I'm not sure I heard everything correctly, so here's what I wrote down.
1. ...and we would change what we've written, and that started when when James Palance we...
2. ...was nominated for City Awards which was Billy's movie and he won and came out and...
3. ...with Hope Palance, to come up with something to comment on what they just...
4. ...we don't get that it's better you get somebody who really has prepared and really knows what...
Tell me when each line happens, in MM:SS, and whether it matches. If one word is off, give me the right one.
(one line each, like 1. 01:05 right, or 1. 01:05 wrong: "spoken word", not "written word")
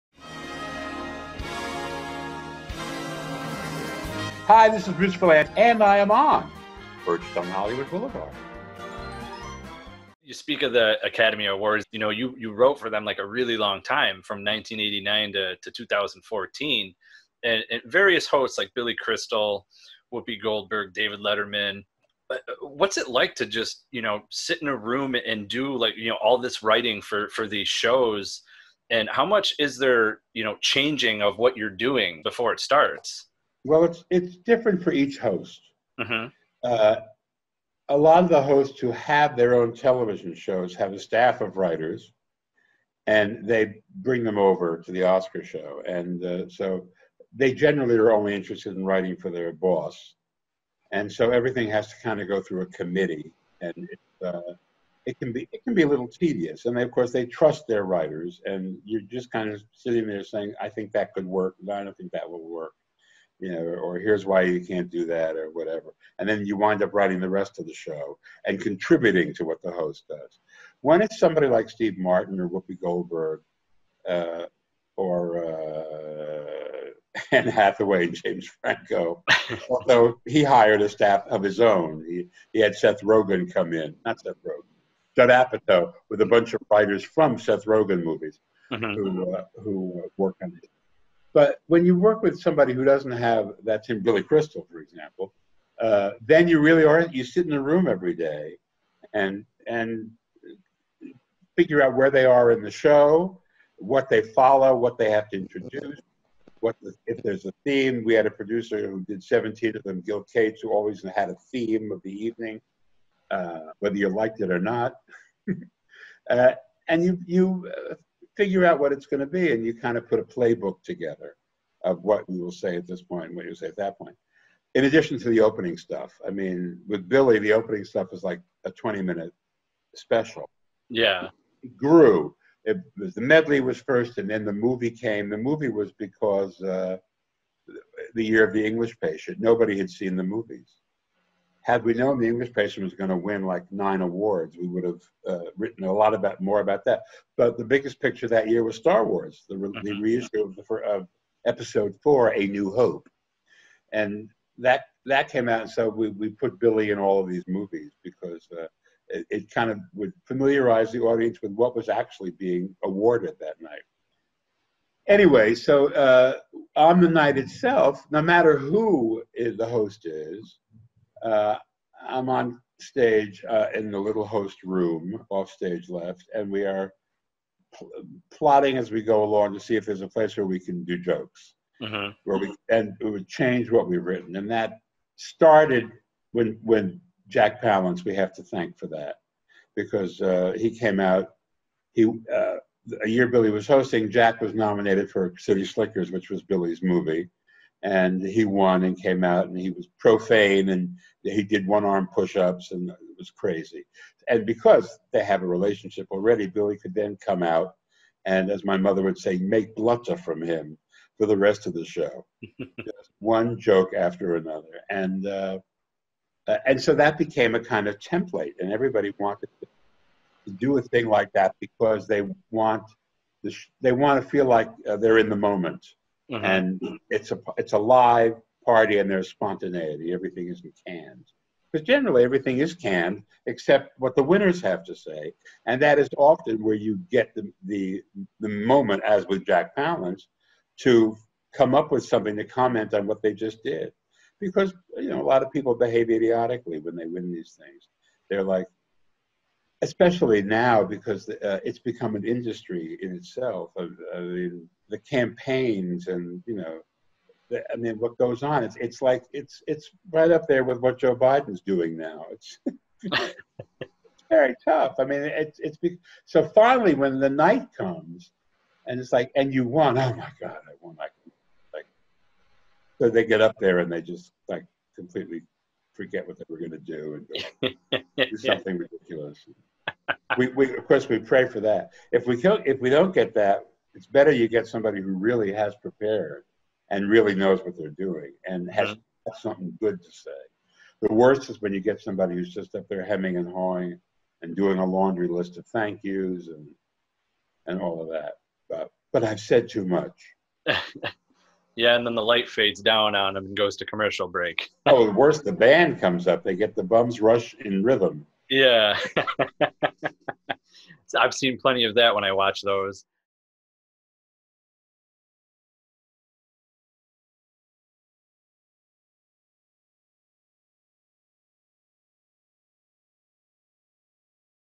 1. 03:02 wrong: "Jack", not "James"
2. 03:14 wrong: "Slickers", not "Awards"
3. 03:59 wrong: "Jack", not "Hope"
4. 04:42 right.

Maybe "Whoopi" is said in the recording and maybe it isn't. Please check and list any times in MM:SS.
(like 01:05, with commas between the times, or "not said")
00:20, 01:12.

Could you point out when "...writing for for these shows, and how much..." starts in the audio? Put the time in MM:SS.
00:26.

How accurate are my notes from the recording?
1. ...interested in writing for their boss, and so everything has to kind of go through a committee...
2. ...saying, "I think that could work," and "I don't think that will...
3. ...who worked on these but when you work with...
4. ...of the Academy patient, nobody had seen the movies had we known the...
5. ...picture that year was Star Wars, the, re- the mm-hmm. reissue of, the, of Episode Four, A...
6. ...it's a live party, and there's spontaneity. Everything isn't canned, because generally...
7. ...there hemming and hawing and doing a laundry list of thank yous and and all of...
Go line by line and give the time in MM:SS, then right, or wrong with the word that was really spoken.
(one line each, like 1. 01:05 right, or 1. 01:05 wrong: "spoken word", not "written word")
1. 00:48 right
2. 01:00 right
3. 01:29 right
4. 02:18 wrong: "English", not "Academy"
5. 02:28 right
6. 03:47 right
7. 04:52 right.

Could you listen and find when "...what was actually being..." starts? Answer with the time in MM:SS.
02:41.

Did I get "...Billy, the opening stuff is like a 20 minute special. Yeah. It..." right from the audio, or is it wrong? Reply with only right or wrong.
right.